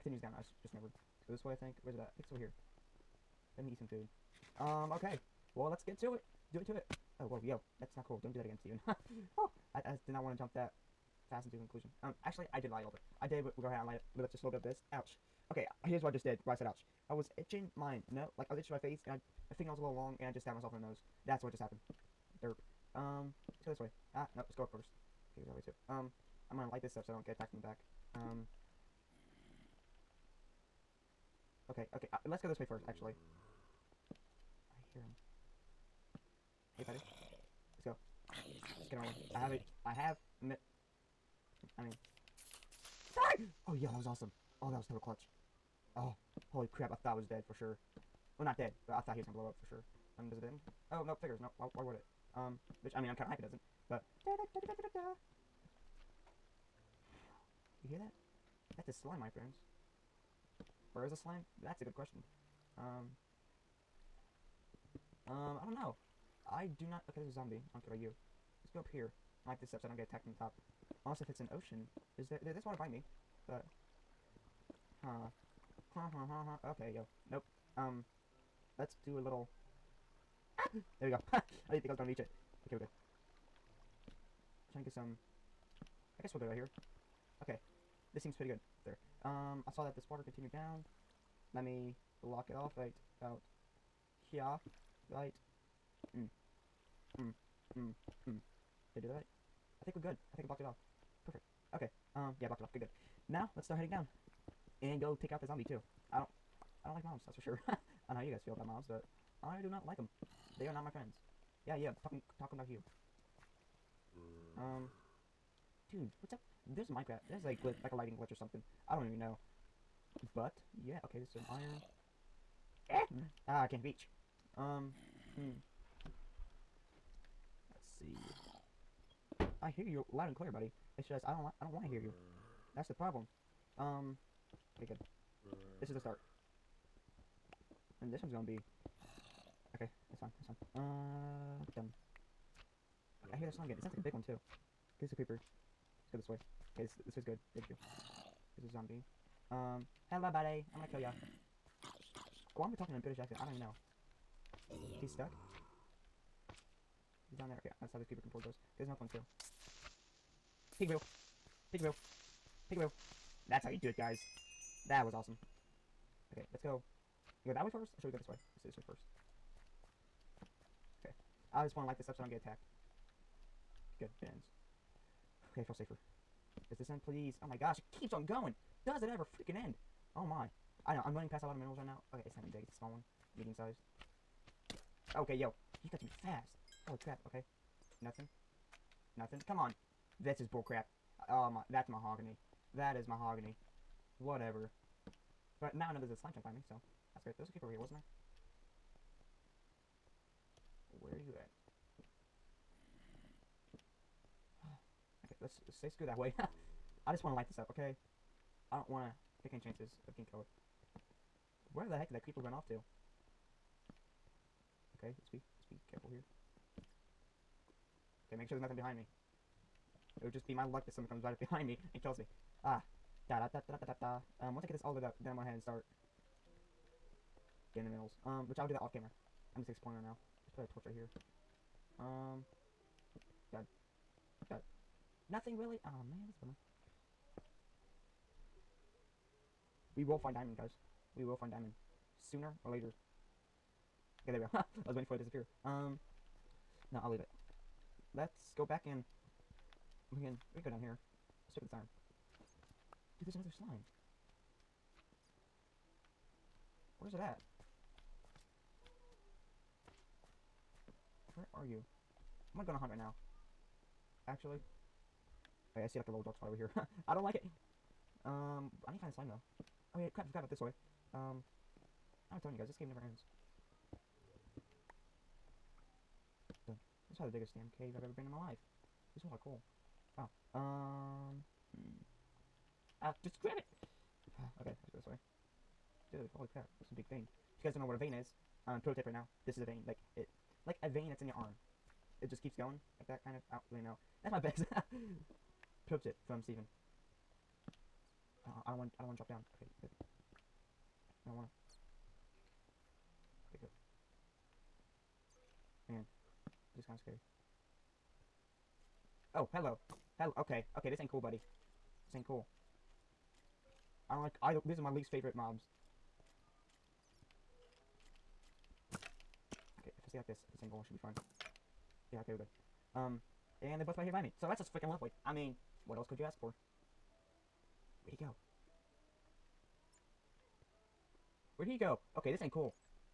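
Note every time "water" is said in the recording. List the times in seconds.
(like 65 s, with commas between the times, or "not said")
72 s, 90 s.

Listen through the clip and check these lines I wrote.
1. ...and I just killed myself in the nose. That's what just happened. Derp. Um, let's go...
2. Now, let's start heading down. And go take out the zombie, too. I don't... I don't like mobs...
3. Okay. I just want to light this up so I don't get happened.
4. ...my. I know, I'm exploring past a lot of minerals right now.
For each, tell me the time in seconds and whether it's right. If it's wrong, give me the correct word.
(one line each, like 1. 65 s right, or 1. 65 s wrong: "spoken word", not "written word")
1. 20 s wrong: "stabbed", not "killed"
2. 103 s right
3. 171 s wrong: "attacked", not "happened"
4. 180 s wrong: "running", not "exploring".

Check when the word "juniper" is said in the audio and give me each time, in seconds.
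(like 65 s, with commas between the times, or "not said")
not said.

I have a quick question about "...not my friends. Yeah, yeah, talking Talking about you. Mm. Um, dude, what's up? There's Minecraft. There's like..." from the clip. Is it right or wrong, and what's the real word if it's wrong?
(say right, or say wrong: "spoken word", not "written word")
right.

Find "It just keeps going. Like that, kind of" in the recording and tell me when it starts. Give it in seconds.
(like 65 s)
292 s.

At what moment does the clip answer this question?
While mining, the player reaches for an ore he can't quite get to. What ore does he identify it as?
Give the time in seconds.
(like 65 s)
121 s.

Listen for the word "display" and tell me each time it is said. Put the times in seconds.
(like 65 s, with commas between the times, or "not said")
not said.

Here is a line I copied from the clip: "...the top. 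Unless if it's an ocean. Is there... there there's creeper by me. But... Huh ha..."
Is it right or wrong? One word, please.
wrong.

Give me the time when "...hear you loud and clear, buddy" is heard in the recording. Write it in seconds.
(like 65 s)
129 s.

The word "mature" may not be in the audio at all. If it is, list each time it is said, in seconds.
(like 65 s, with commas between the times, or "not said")
not said.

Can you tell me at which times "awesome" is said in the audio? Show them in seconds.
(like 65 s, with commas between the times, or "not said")
44 s, 165 s.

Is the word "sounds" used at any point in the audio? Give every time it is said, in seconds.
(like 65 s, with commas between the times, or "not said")
143 s.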